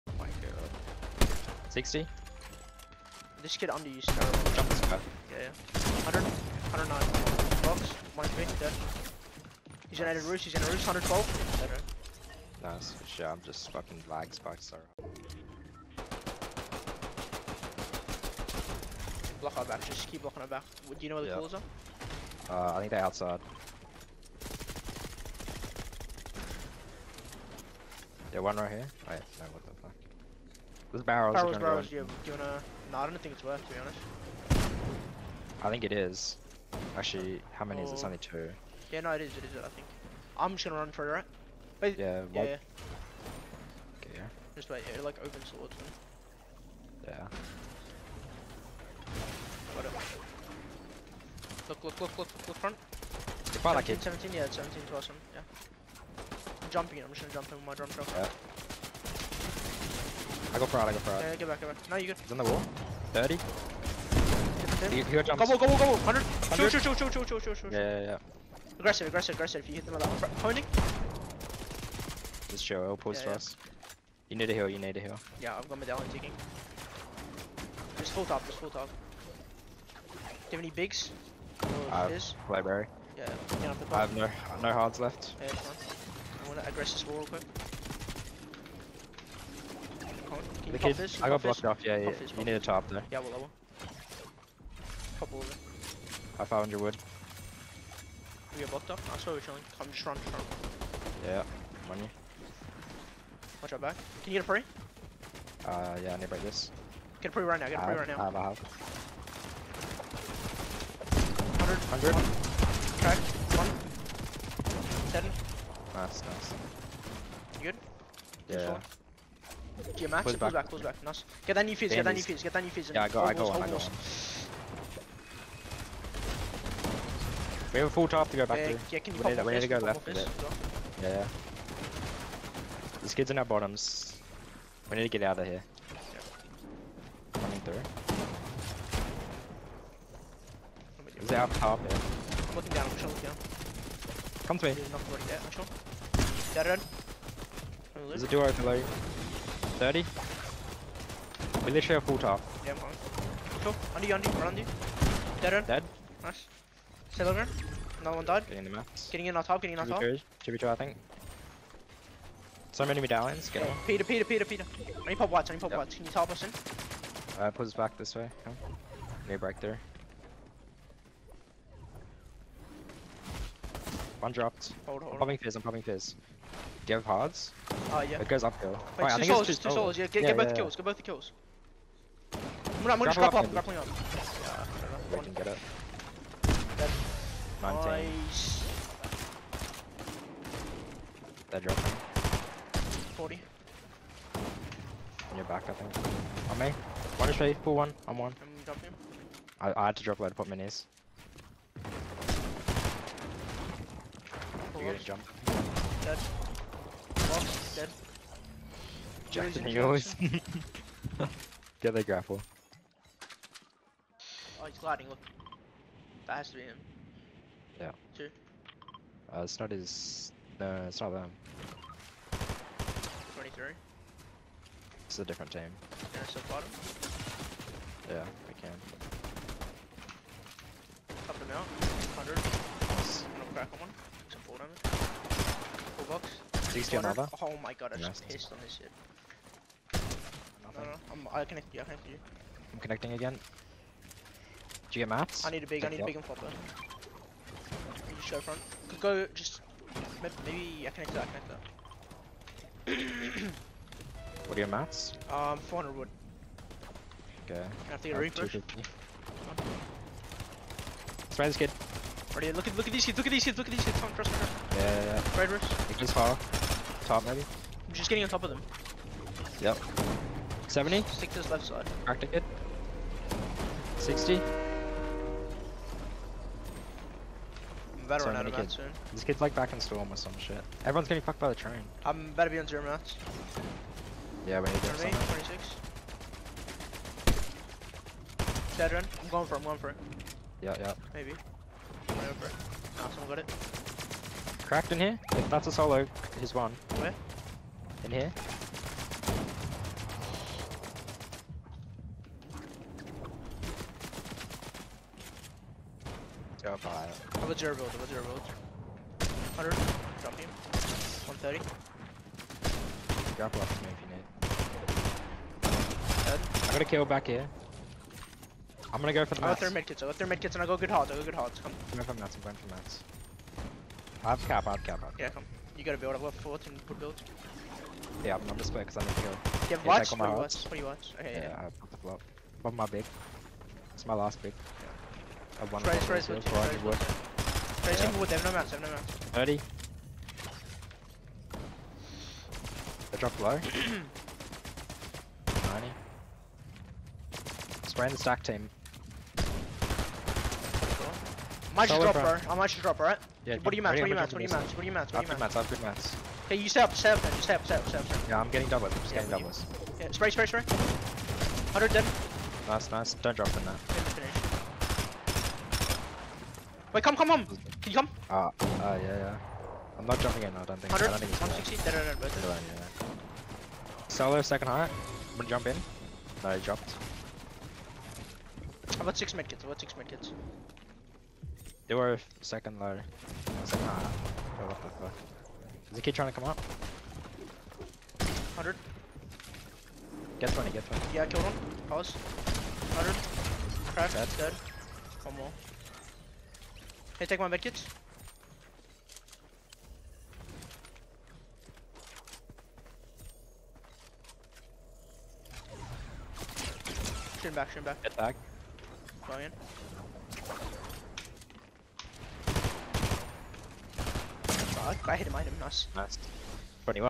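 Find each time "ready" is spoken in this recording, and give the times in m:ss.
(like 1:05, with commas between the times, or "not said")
3:17, 4:22.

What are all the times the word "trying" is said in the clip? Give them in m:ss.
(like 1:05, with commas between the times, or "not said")
6:26.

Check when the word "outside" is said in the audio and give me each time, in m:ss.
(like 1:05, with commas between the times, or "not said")
0:22.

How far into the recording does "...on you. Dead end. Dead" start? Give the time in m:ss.
2:34.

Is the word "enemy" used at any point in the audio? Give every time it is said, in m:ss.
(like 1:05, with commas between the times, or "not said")
2:42.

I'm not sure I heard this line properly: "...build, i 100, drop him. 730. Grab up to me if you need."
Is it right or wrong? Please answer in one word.
wrong.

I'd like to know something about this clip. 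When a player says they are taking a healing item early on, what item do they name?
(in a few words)
medallion.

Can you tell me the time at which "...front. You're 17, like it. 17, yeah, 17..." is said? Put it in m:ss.
0:52.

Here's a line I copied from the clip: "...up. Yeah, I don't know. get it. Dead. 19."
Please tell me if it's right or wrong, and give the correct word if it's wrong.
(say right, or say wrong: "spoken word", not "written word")
right.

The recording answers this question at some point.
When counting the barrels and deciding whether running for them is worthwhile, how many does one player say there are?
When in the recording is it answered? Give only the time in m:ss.
0:38.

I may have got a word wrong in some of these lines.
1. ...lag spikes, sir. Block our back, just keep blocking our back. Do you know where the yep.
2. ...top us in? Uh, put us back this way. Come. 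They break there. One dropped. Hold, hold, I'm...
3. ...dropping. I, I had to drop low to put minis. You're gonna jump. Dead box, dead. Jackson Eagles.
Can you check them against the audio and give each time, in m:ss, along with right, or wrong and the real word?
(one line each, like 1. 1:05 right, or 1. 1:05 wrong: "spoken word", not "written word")
1. 0:14 right
2. 2:46 right
3. 3:18 right.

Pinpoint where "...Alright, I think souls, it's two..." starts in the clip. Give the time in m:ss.
2:59.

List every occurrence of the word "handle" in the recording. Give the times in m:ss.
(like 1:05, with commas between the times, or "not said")
not said.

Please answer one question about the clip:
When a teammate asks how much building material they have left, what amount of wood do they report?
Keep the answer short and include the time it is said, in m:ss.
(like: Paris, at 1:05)
400 wood, at 4:15.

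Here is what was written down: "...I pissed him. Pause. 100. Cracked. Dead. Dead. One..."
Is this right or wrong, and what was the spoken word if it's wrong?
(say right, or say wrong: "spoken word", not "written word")
wrong: "killed", not "pissed".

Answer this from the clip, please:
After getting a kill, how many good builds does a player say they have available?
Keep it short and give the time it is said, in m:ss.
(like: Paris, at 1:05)
14, at 5:26.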